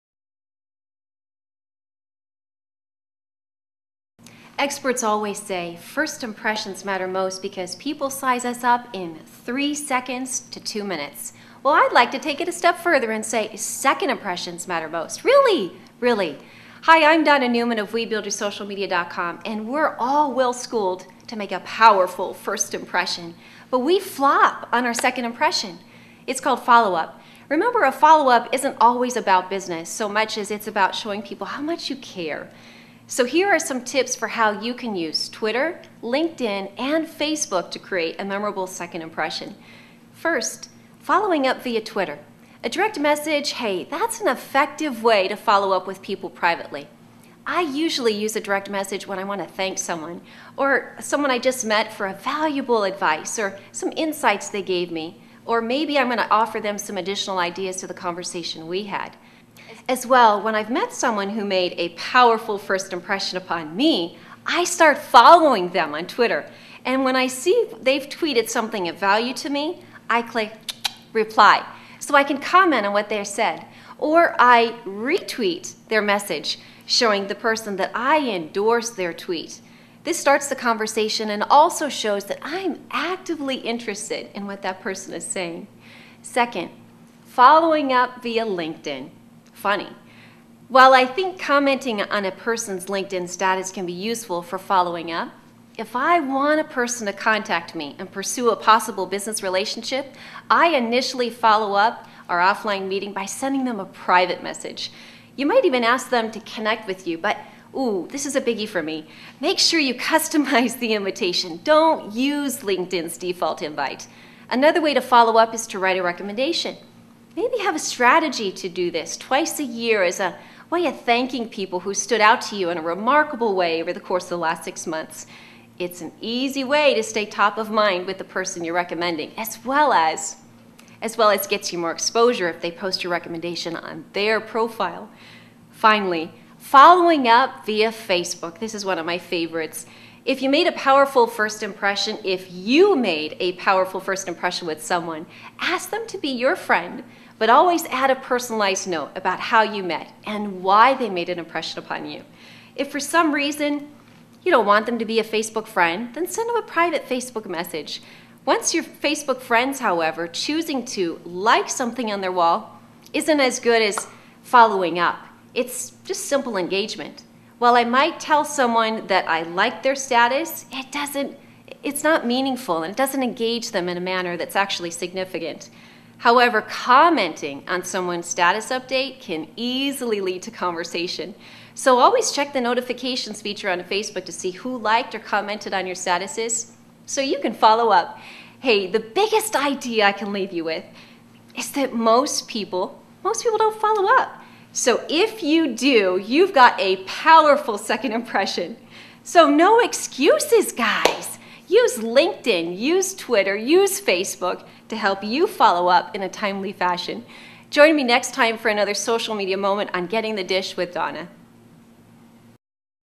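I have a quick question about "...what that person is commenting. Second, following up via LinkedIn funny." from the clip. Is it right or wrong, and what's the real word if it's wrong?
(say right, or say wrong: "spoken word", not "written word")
wrong: "saying", not "commenting".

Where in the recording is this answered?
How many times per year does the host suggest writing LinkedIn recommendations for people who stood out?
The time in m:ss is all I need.
1:59.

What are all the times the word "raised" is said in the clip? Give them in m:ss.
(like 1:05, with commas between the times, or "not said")
not said.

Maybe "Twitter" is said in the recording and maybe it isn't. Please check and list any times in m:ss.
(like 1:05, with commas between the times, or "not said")
0:35, 0:41, 1:06, 3:23.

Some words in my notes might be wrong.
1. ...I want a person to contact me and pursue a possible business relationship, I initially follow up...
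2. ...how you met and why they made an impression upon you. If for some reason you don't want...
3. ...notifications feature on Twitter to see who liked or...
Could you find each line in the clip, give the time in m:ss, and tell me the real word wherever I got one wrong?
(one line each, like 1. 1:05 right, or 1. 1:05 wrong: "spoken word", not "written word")
1. 1:35 right
2. 2:29 right
3. 3:02 wrong: "Facebook", not "Twitter".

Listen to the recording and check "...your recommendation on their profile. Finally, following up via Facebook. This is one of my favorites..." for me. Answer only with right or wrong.
right.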